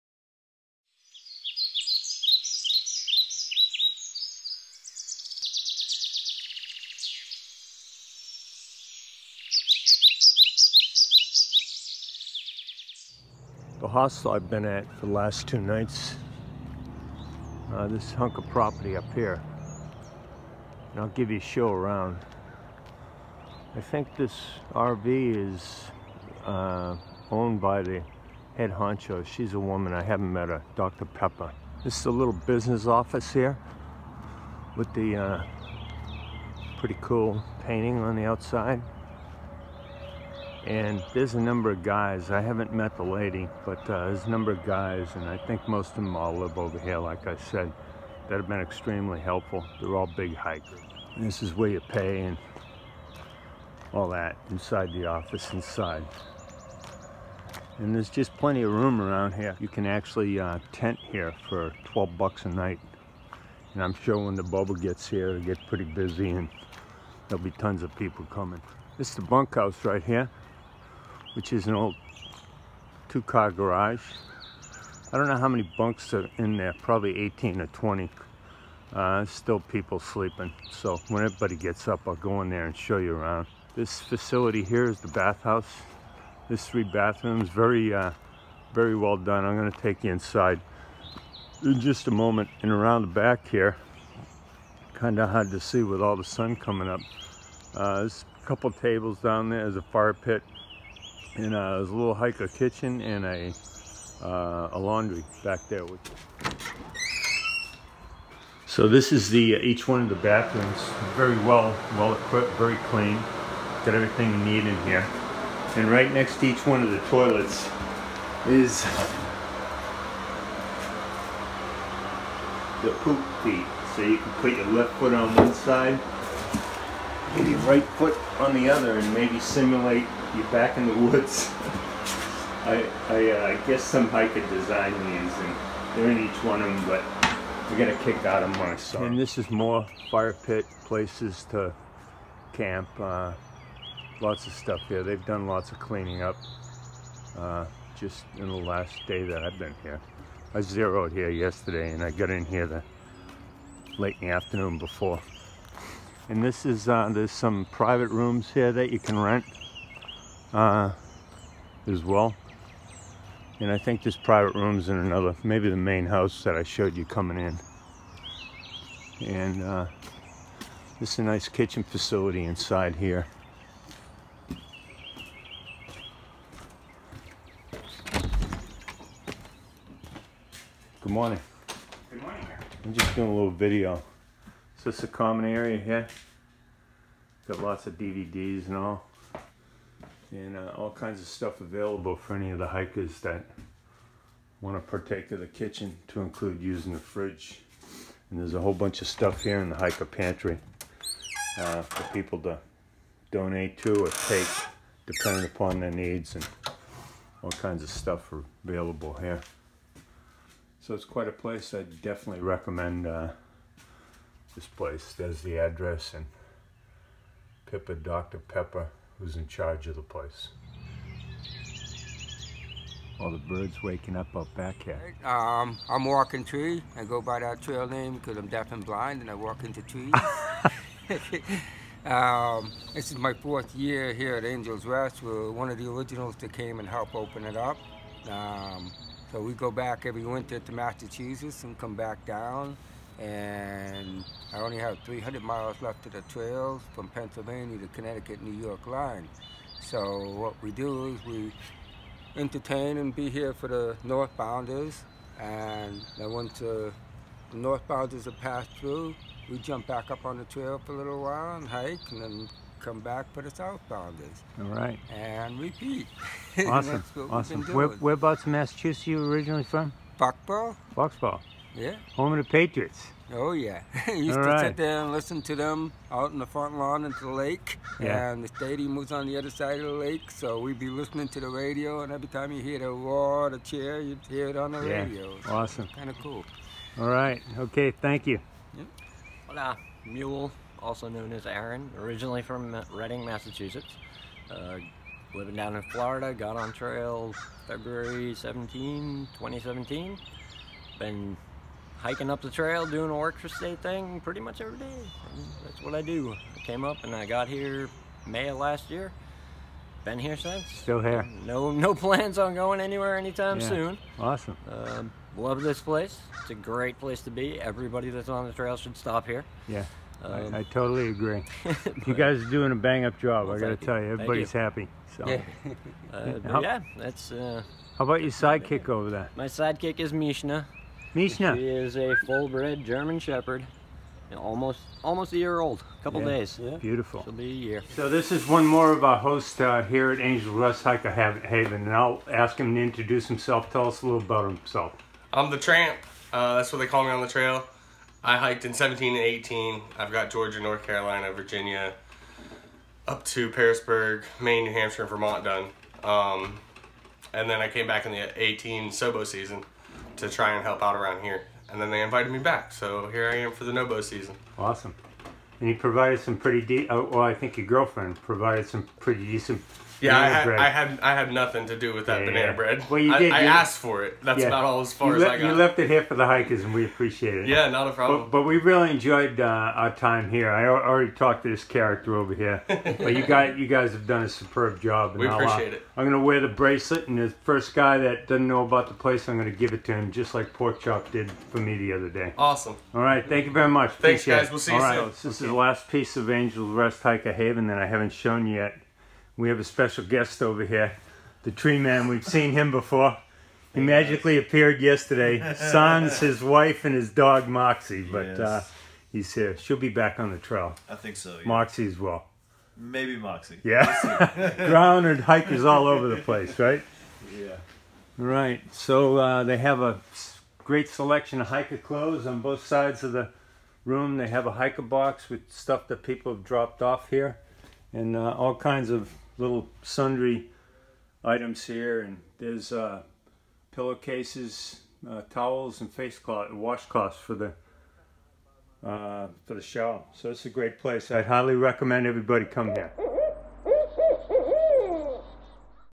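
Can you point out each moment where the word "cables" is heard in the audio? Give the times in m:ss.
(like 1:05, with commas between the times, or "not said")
not said.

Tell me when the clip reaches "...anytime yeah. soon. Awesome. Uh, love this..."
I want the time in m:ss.
5:13.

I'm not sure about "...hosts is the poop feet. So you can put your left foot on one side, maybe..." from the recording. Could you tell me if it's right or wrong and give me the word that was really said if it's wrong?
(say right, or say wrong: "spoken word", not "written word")
wrong: "toilets", not "hosts".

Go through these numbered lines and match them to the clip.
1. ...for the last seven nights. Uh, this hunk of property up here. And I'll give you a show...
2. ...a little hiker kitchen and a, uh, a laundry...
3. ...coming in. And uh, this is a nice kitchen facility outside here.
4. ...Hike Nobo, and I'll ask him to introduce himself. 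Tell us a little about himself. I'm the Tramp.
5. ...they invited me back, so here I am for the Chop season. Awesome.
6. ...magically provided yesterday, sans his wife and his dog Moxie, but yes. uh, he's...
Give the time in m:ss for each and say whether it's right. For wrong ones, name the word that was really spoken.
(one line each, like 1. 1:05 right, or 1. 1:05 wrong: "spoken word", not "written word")
1. 0:14 wrong: "two", not "seven"
2. 1:41 right
3. 2:47 wrong: "inside", not "outside"
4. 5:40 wrong: "Haven", not "Nobo"
5. 6:01 wrong: "Nobo", not "Chop"
6. 6:43 wrong: "appeared", not "provided".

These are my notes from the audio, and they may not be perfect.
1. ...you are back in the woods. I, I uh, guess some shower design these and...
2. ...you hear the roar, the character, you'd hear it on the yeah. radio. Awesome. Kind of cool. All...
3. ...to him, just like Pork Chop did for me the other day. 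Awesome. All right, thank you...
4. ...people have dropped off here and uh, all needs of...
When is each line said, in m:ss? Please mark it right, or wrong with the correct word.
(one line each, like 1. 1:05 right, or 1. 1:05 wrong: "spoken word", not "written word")
1. 2:10 wrong: "hiker", not "shower"
2. 4:42 wrong: "cheer", not "character"
3. 6:29 right
4. 7:06 wrong: "kinds", not "needs".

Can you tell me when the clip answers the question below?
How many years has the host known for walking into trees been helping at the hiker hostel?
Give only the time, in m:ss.
3:53.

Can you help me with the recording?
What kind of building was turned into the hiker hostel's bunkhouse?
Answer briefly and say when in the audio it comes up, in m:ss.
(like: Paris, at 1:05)
Two-car garage, at 1:13.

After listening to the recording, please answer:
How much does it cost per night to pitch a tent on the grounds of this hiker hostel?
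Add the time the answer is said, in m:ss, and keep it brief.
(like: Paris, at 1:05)
$12, at 1:01.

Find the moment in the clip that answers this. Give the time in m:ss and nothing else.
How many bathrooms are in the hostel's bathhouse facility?
1:26.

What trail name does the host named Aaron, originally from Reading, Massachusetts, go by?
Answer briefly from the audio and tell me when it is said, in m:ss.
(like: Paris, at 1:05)
Mule, at 4:50.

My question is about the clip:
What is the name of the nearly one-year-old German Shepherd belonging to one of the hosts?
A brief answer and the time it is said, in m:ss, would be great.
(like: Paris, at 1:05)
Mishna, at 5:30.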